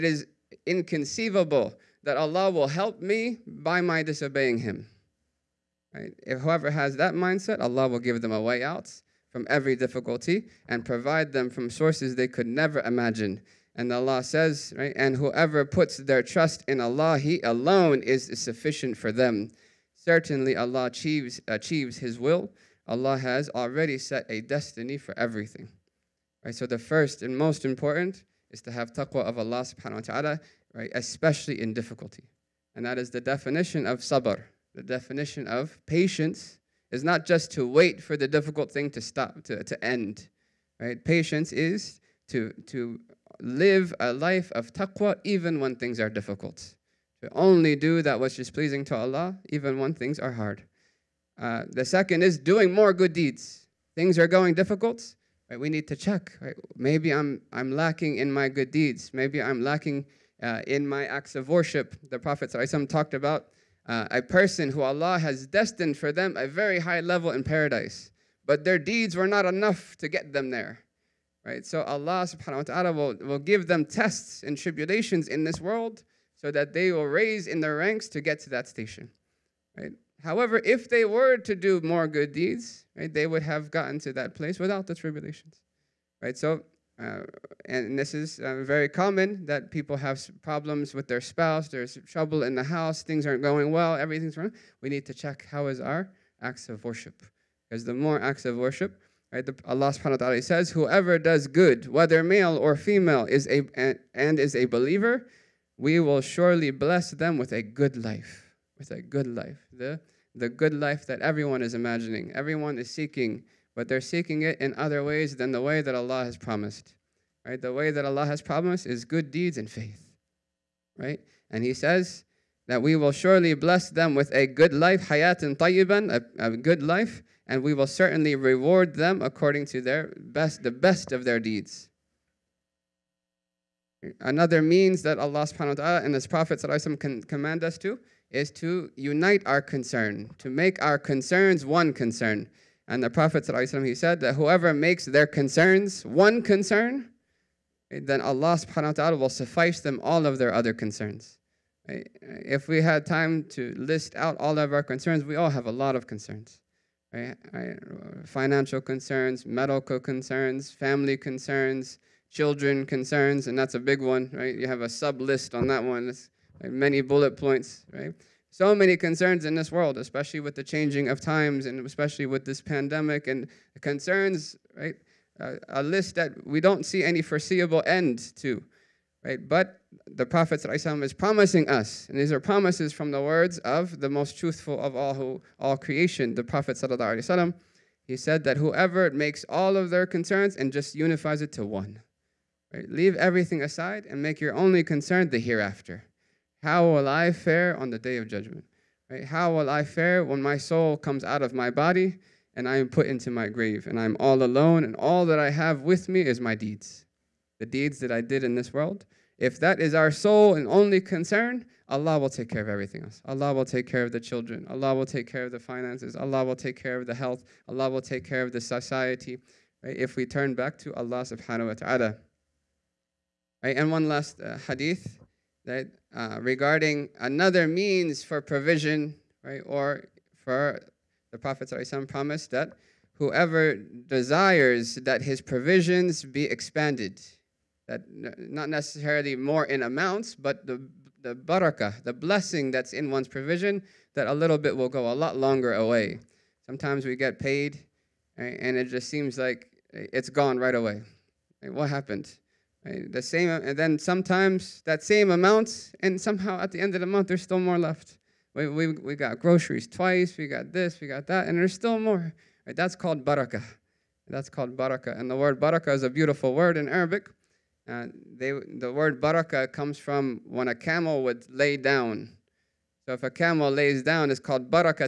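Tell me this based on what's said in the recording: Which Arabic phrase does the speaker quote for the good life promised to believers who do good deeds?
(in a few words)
hayatun tayyiban.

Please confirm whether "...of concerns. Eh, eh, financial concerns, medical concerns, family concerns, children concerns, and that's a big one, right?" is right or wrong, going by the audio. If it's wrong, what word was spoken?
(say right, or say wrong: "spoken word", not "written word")
right.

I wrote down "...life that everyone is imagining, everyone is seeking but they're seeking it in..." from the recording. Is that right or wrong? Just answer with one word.
right.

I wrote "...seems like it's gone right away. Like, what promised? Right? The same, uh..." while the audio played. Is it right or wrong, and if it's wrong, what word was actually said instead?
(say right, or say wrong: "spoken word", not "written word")
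wrong: "happened", not "promised".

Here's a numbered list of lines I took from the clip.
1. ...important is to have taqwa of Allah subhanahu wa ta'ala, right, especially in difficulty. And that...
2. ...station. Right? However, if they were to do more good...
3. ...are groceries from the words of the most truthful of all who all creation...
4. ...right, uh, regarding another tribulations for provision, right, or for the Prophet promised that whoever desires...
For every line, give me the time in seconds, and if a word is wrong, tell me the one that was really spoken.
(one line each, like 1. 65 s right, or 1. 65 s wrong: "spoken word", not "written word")
1. 27 s right
2. 78 s right
3. 182 s wrong: "promises", not "groceries"
4. 225 s wrong: "means", not "tribulations".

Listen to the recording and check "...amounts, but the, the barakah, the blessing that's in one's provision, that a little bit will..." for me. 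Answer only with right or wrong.
right.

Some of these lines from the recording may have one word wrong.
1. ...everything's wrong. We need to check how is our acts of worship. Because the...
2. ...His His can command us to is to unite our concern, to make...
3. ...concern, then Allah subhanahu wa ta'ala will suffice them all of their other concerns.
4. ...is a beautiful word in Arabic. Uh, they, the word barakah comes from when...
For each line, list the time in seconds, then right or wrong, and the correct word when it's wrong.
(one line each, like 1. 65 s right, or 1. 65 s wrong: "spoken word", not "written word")
1. 93 s right
2. 136 s wrong: "Prophet", not "His"
3. 146 s right
4. 265 s right.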